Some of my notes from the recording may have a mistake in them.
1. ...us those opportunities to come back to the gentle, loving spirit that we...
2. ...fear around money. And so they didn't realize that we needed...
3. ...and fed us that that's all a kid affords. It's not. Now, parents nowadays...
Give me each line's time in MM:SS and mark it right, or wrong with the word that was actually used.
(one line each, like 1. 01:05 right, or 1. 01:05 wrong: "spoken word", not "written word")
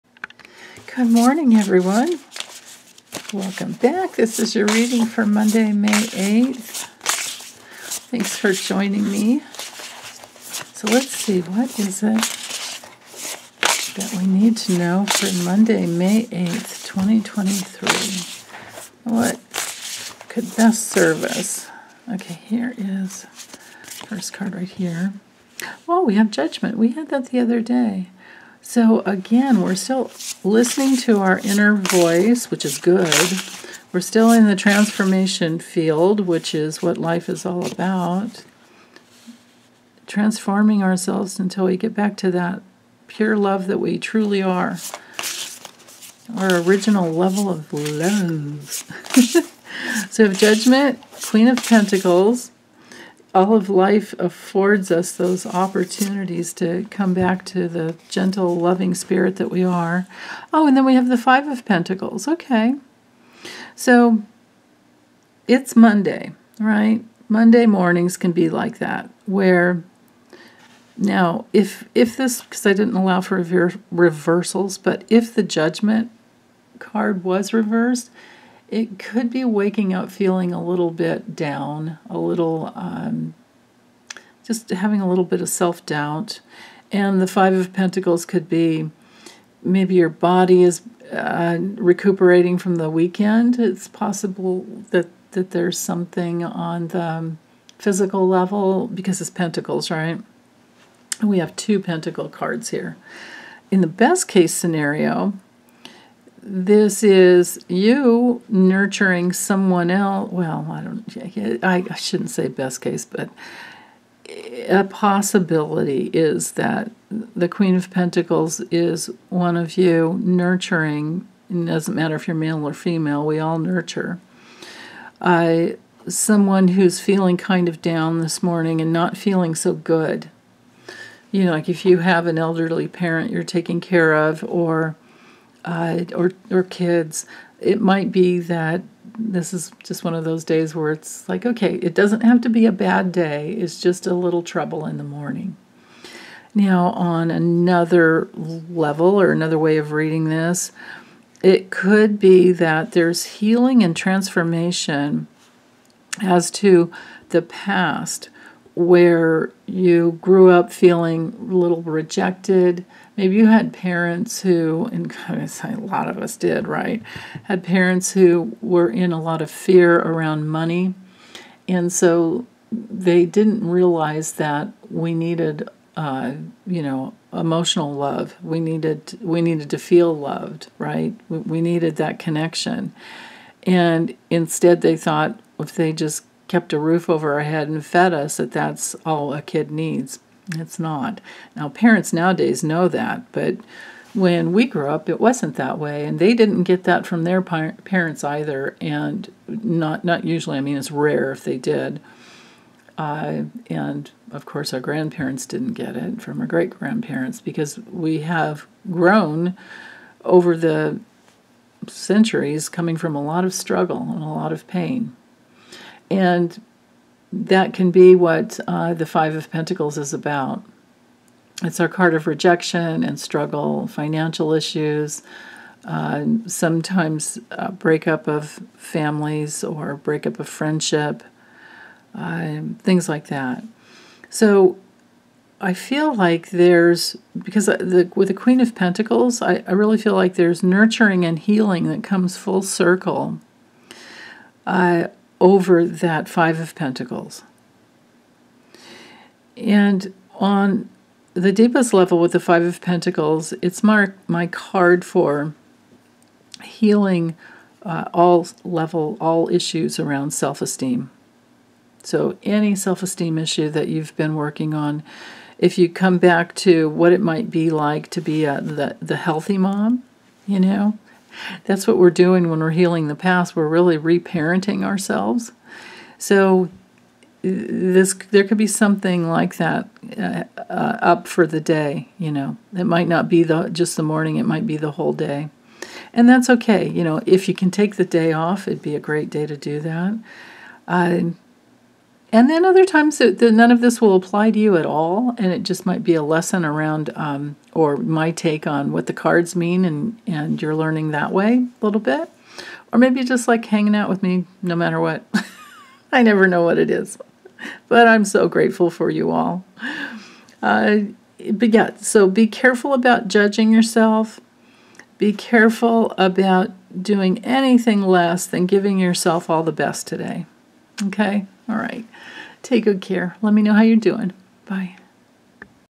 1. 00:54 right
2. 02:49 right
3. 03:07 wrong: "needs", not "affords".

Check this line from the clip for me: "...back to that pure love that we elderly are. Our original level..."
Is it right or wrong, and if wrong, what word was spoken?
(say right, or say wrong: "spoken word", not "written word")
wrong: "truly", not "elderly".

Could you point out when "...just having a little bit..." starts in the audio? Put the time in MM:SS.
01:24.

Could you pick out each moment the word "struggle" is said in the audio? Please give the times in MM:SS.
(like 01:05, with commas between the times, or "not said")
03:33, 03:43.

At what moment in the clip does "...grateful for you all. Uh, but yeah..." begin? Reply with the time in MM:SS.
05:08.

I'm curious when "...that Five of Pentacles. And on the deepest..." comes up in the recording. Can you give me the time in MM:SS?
04:05.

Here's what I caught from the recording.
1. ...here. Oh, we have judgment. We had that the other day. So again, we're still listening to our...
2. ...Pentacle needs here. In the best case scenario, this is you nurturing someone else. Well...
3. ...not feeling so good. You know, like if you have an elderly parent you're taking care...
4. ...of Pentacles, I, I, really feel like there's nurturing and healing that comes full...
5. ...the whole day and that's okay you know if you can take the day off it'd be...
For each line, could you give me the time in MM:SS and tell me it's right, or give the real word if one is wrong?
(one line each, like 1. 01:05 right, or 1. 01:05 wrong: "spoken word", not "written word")
1. 00:24 right
2. 01:41 wrong: "cards", not "needs"
3. 02:08 right
4. 03:58 right
5. 04:44 right.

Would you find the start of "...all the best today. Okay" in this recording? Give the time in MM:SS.
05:19.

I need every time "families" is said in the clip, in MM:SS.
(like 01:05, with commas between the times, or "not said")
03:48.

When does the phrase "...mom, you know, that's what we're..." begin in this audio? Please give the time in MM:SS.
04:29.